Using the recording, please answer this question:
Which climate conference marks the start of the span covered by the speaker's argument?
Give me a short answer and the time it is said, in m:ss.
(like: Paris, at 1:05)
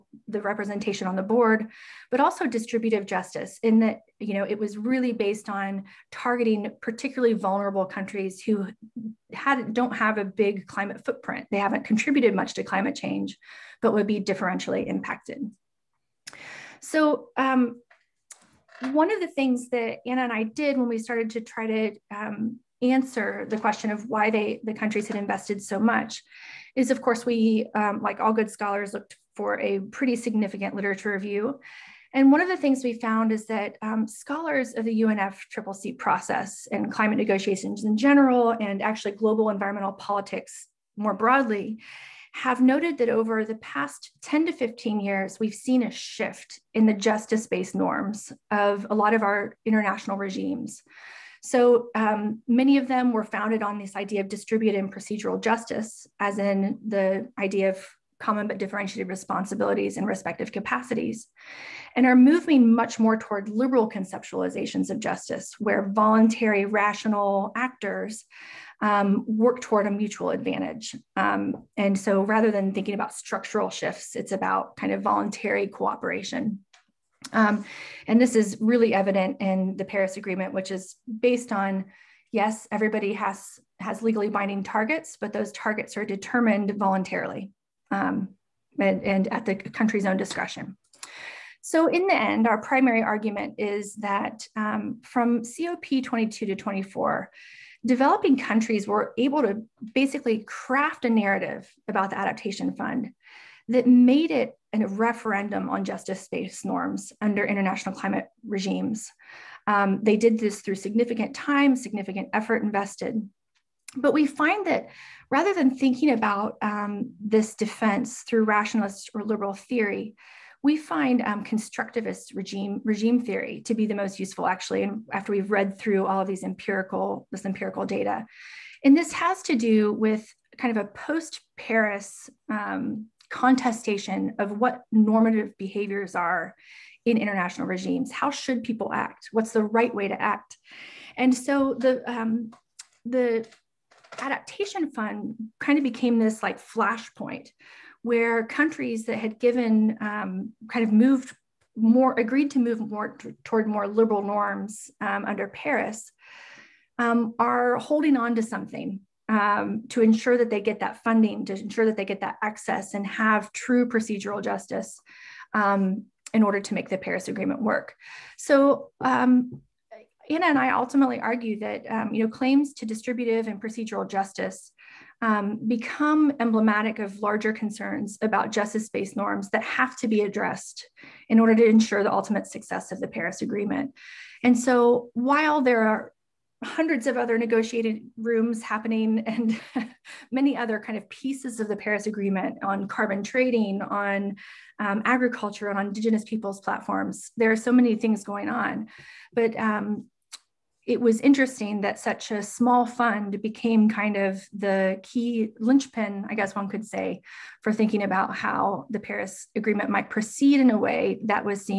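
COP 22, at 1:35.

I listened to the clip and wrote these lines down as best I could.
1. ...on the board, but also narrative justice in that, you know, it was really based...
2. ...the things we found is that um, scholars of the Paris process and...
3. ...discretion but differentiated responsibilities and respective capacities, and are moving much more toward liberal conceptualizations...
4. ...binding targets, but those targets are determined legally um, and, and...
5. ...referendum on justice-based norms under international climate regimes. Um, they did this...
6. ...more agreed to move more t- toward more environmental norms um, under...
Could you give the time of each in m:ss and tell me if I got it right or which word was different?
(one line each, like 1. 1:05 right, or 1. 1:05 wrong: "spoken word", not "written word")
1. 0:01 wrong: "distributive", not "narrative"
2. 0:32 wrong: "UNFCCC", not "Paris"
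3. 0:58 wrong: "common", not "discretion"
4. 1:24 wrong: "voluntarily", not "legally"
5. 1:44 right
6. 2:31 wrong: "liberal", not "environmental".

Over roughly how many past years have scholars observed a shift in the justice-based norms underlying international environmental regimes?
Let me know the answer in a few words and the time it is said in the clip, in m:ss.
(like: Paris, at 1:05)
10 to 15 years, at 0:44.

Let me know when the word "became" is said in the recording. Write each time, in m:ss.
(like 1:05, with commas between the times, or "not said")
2:25, 3:23.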